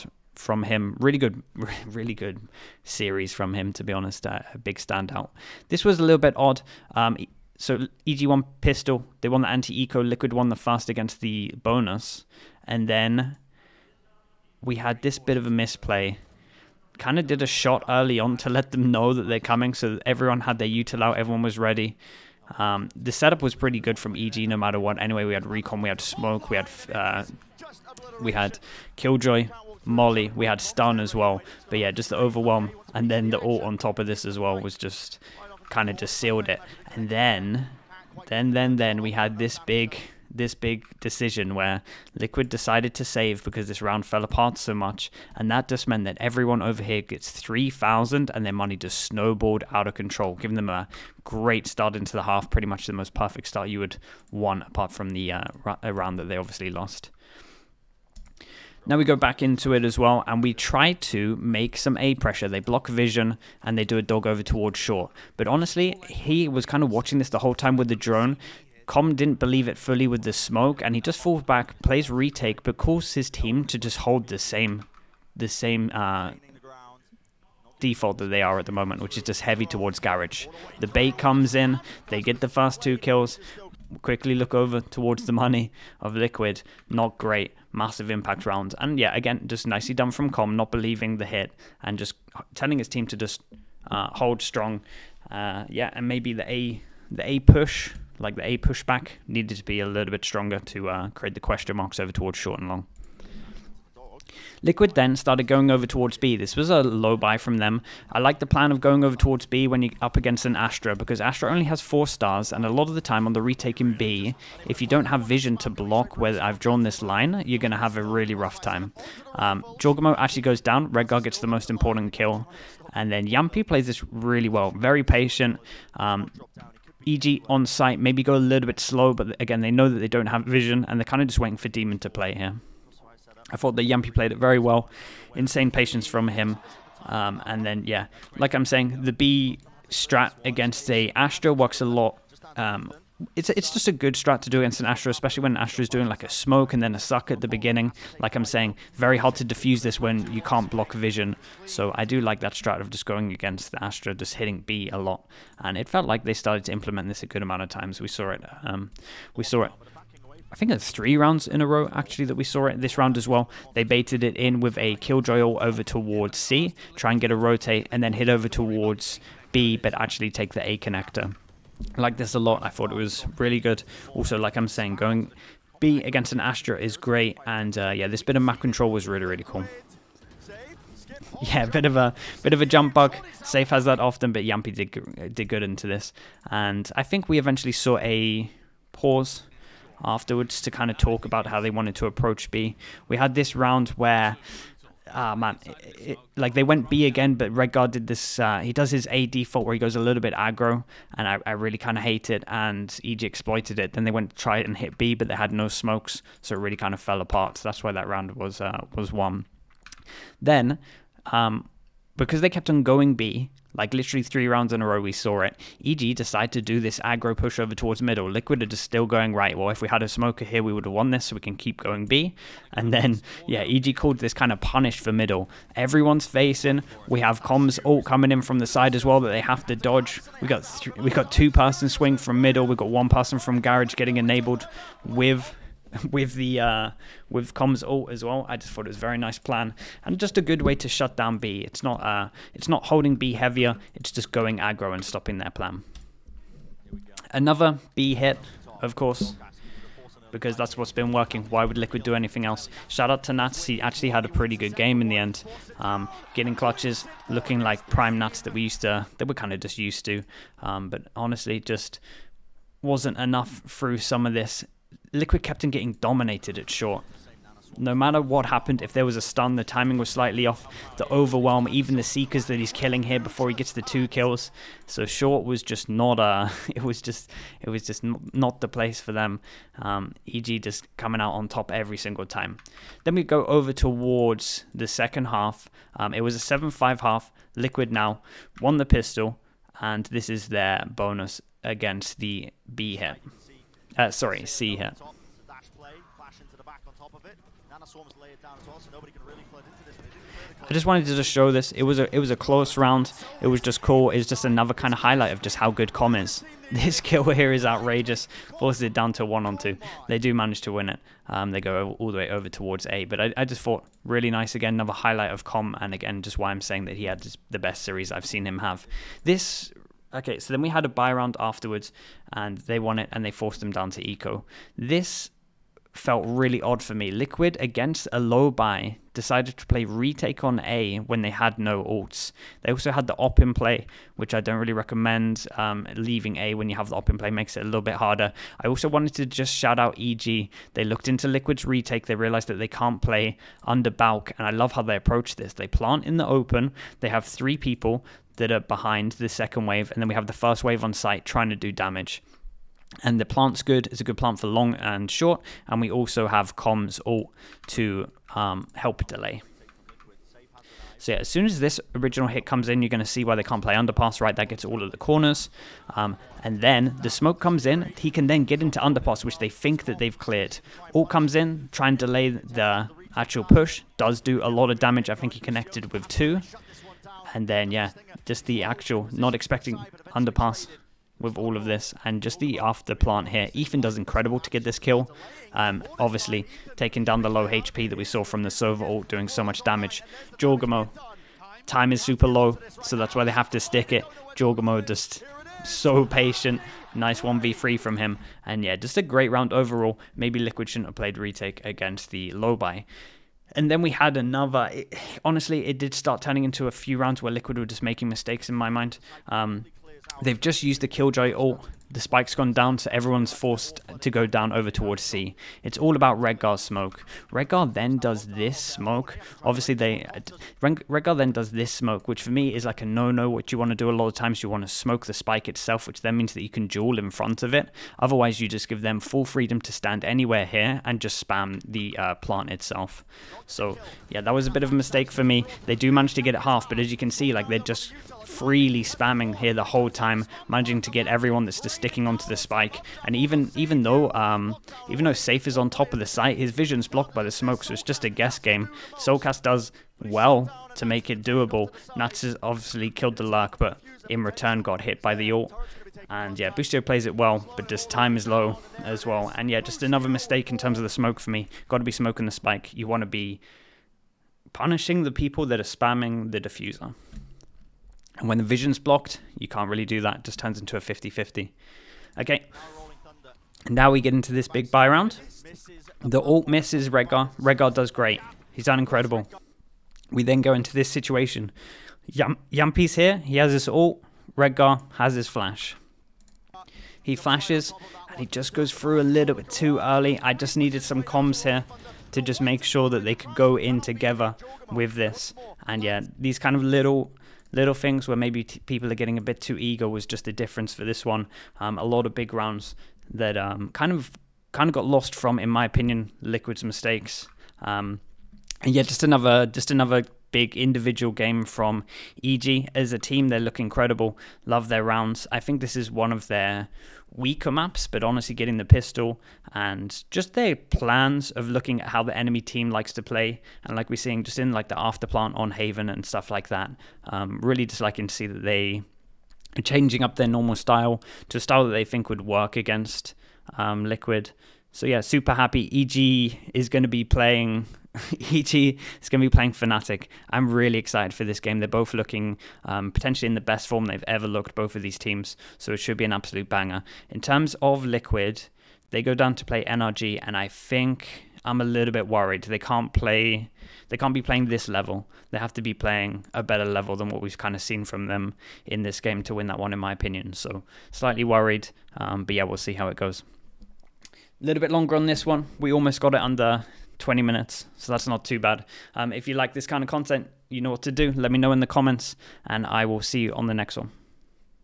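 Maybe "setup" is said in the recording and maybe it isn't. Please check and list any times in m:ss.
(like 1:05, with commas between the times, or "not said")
0:23.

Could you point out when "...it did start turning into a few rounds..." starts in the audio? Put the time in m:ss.
6:45.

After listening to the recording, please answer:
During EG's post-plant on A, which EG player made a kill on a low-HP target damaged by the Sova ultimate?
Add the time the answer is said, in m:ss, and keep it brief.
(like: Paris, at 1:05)
Ethan, at 6:23.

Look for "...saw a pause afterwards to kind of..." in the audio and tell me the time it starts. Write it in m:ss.
3:07.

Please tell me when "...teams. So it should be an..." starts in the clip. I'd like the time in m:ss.
9:04.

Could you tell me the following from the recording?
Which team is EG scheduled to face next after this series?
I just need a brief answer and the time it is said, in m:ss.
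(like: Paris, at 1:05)
Fnatic, at 8:59.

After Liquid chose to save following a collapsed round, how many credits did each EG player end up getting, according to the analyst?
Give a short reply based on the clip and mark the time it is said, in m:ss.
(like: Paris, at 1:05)
3,000, at 0:47.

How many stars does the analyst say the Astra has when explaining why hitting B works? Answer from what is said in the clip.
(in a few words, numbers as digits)
4.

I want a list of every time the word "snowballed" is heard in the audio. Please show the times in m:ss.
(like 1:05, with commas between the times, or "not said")
0:48.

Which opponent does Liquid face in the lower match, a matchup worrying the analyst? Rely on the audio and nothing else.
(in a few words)
NRG.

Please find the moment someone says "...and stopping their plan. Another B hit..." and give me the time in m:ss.
4:04.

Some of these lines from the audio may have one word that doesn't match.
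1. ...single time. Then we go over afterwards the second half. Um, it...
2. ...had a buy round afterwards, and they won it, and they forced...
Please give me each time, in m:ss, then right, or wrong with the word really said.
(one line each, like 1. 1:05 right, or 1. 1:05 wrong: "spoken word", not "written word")
1. 4:41 wrong: "towards", not "afterwards"
2. 5:20 right.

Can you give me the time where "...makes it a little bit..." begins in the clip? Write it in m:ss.
5:37.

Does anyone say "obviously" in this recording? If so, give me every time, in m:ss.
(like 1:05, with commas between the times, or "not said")
0:56, 6:25, 6:59, 7:32.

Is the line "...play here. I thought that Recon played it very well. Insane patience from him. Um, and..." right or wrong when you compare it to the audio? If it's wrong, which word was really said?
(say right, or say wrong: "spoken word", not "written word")
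wrong: "Jamppi", not "Recon".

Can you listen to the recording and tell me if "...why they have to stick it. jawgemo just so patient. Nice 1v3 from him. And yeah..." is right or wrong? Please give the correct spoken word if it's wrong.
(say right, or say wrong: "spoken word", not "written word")
right.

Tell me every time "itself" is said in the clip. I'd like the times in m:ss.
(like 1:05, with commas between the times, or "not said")
7:05, 7:12.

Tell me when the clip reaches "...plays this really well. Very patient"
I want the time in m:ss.
2:03.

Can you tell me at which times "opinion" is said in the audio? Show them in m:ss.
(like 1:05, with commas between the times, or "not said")
8:25, 9:19.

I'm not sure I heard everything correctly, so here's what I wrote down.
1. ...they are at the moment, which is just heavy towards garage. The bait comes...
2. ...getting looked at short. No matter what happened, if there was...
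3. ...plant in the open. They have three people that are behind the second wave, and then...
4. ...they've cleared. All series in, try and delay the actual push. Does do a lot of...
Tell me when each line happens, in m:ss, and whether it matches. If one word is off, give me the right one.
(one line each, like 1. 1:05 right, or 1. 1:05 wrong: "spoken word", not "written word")
1. 1:18 right
2. 4:25 wrong: "dominated", not "looked"
3. 5:45 right
4. 6:09 wrong: "comes", not "series".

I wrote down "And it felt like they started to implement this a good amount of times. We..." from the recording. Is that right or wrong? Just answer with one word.
right.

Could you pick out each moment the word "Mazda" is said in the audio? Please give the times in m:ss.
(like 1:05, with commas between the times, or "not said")
not said.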